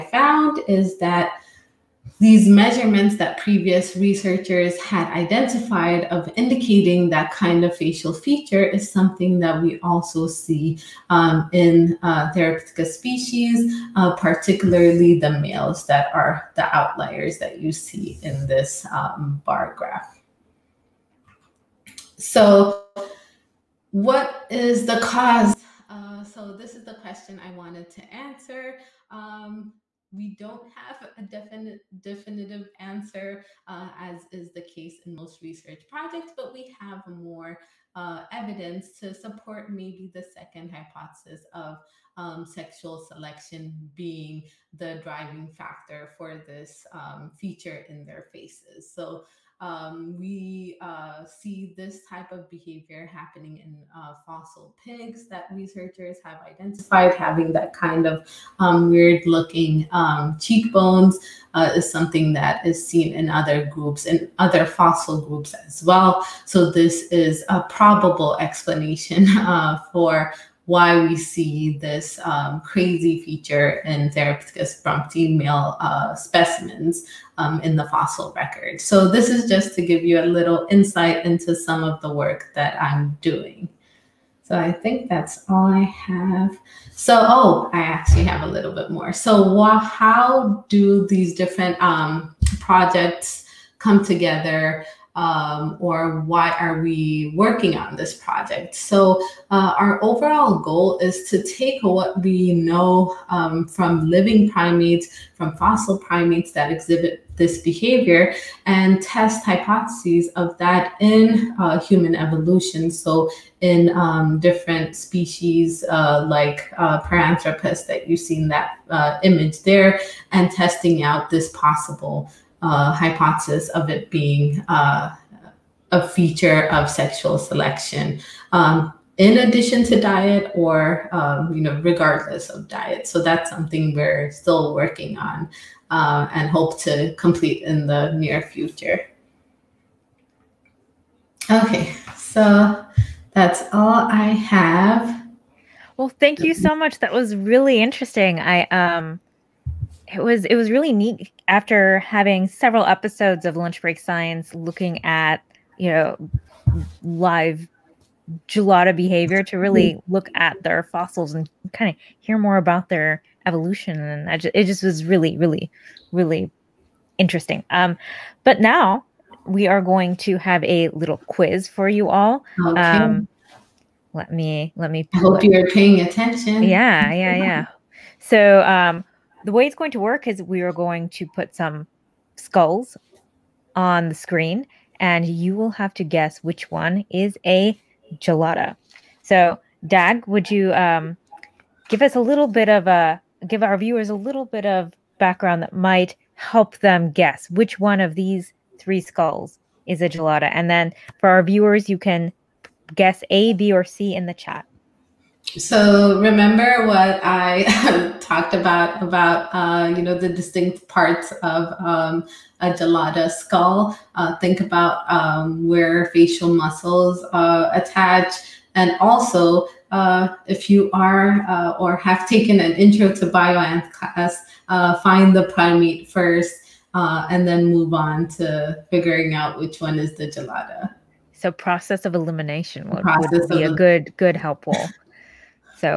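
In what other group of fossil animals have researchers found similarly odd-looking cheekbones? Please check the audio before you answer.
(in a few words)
Fossil pigs.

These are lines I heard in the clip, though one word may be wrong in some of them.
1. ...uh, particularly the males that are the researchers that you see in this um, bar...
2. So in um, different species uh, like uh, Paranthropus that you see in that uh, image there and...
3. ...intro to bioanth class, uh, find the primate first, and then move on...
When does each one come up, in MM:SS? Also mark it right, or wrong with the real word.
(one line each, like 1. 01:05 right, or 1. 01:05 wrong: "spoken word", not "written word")
1. 00:13 wrong: "outliers", not "researchers"
2. 01:52 right
3. 03:42 right.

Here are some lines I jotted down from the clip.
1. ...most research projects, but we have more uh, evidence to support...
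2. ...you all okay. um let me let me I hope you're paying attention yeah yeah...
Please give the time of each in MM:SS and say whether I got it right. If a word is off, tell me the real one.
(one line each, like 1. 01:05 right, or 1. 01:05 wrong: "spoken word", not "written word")
1. 00:35 right
2. 02:51 right.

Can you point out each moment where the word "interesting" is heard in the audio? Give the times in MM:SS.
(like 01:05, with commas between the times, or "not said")
02:27, 02:47.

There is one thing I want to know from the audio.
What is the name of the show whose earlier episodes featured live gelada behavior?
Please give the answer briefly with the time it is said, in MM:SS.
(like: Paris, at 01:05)
Lunch Break Science, at 02:33.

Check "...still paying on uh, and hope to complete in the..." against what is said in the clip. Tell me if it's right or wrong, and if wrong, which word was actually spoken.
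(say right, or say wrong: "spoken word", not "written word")
wrong: "working", not "paying".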